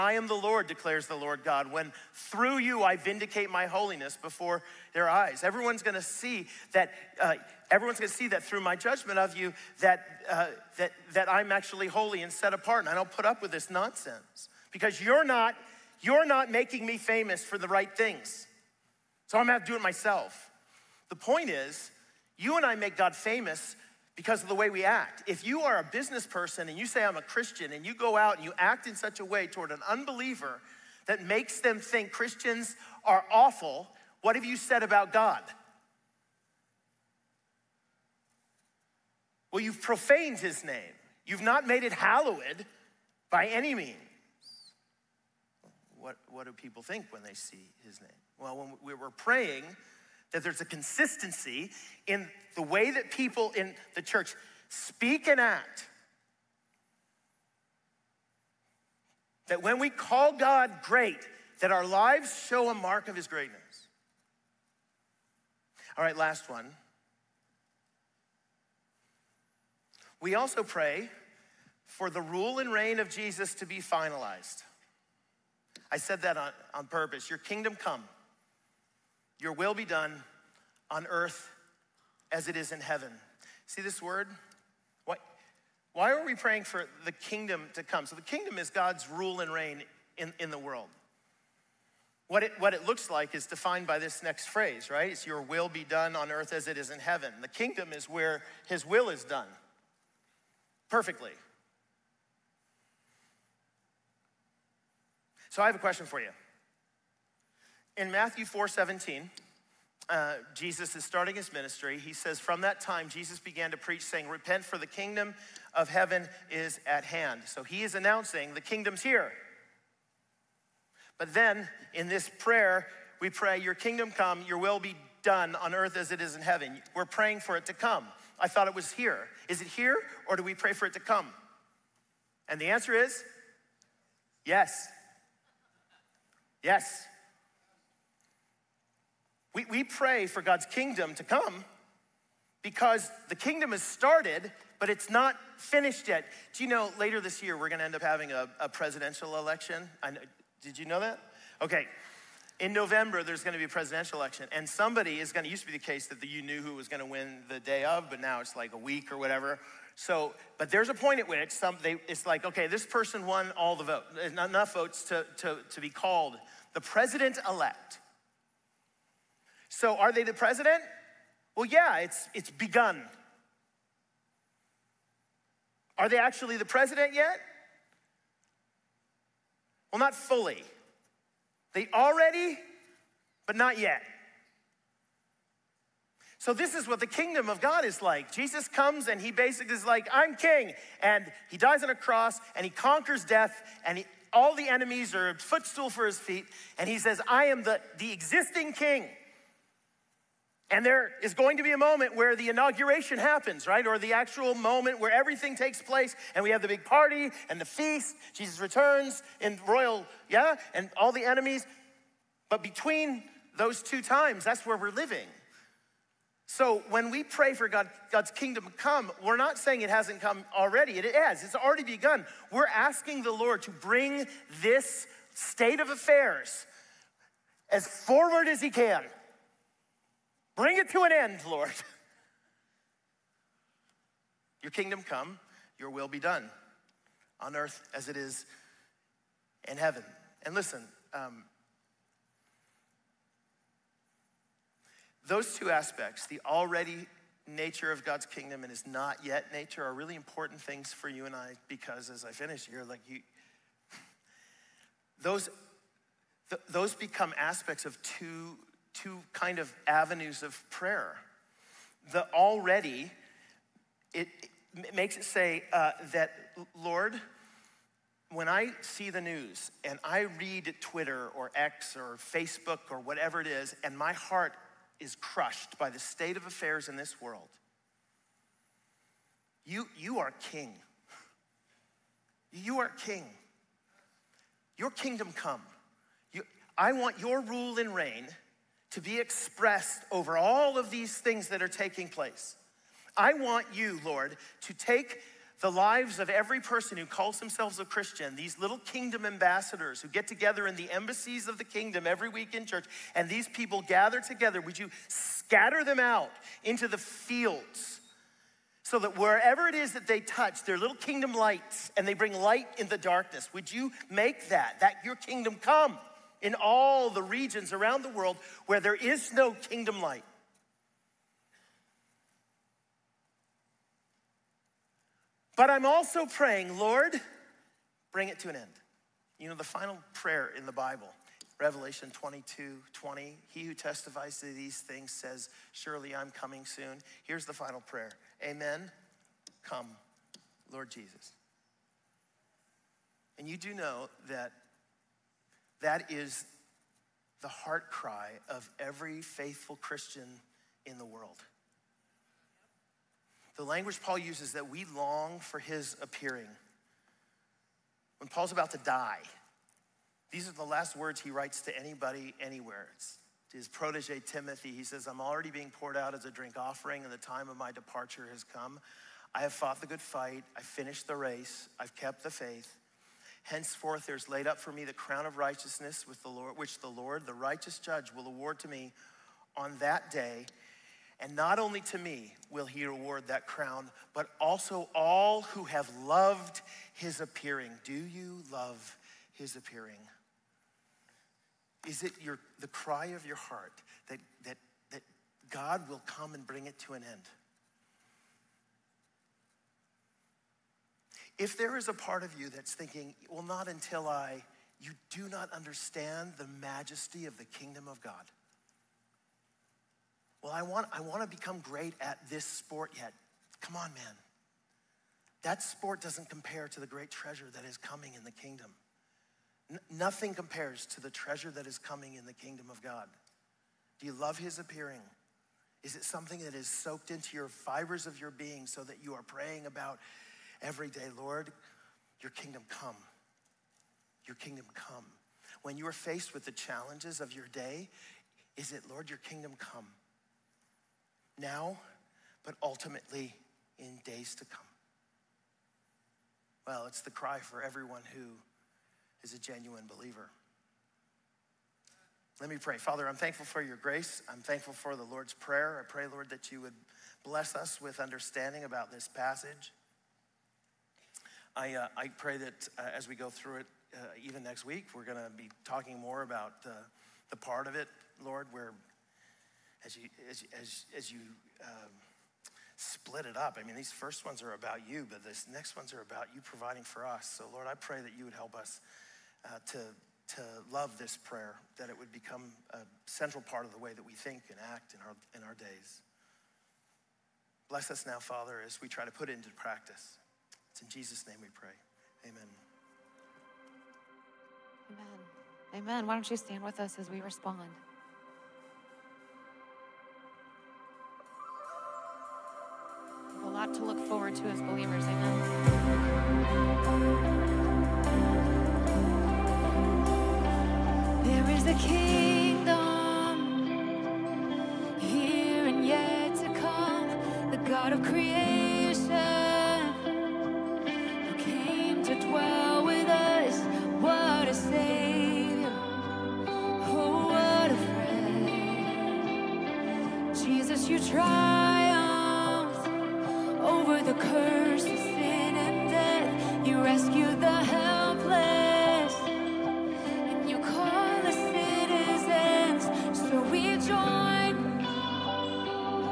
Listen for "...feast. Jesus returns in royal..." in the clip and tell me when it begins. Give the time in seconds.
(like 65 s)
207 s.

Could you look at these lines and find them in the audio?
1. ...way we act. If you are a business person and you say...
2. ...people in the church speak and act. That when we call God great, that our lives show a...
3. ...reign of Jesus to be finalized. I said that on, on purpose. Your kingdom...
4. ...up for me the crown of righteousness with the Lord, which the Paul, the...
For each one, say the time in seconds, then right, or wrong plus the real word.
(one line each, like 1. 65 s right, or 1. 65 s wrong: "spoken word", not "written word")
1. 24 s right
2. 53 s right
3. 72 s right
4. 374 s wrong: "Lord", not "Paul".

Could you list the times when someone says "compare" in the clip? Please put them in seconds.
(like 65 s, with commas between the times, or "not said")
416 s, 420 s.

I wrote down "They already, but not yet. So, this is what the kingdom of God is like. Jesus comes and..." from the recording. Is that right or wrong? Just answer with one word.
right.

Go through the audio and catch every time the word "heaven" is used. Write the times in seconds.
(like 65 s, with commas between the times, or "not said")
82 s, 97 s, 115 s, 126 s, 239 s.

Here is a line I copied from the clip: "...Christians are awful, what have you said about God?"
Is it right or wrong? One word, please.
right.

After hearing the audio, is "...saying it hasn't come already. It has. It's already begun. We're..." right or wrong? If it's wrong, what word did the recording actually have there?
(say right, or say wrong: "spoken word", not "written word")
right.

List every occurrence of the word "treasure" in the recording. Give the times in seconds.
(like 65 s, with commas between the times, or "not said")
417 s, 421 s.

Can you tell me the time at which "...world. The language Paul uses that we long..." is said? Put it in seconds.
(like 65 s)
351 s.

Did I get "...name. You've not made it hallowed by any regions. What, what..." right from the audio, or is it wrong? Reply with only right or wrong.
wrong.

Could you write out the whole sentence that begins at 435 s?
When you are faced with the challenges of your day, is it, Lord, your kingdom come?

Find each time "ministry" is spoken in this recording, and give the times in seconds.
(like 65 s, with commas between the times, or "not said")
111 s.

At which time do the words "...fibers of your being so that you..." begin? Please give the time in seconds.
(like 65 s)
427 s.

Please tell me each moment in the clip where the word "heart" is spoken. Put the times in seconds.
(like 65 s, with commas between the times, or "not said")
274 s, 347 s, 393 s.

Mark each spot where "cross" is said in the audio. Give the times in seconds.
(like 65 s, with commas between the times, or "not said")
191 s.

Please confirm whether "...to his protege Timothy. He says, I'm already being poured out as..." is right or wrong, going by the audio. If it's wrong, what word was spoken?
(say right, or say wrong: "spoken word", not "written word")
right.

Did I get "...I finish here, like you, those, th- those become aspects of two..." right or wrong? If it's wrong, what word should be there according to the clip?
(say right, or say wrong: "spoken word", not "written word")
right.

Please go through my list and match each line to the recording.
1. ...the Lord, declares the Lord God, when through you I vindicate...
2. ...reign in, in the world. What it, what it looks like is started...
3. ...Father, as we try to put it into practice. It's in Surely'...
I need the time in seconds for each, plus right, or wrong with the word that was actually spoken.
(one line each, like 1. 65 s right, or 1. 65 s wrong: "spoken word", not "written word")
1. 0 s right
2. 89 s wrong: "defined", not "started"
3. 488 s wrong: "Jesus", not "Surely".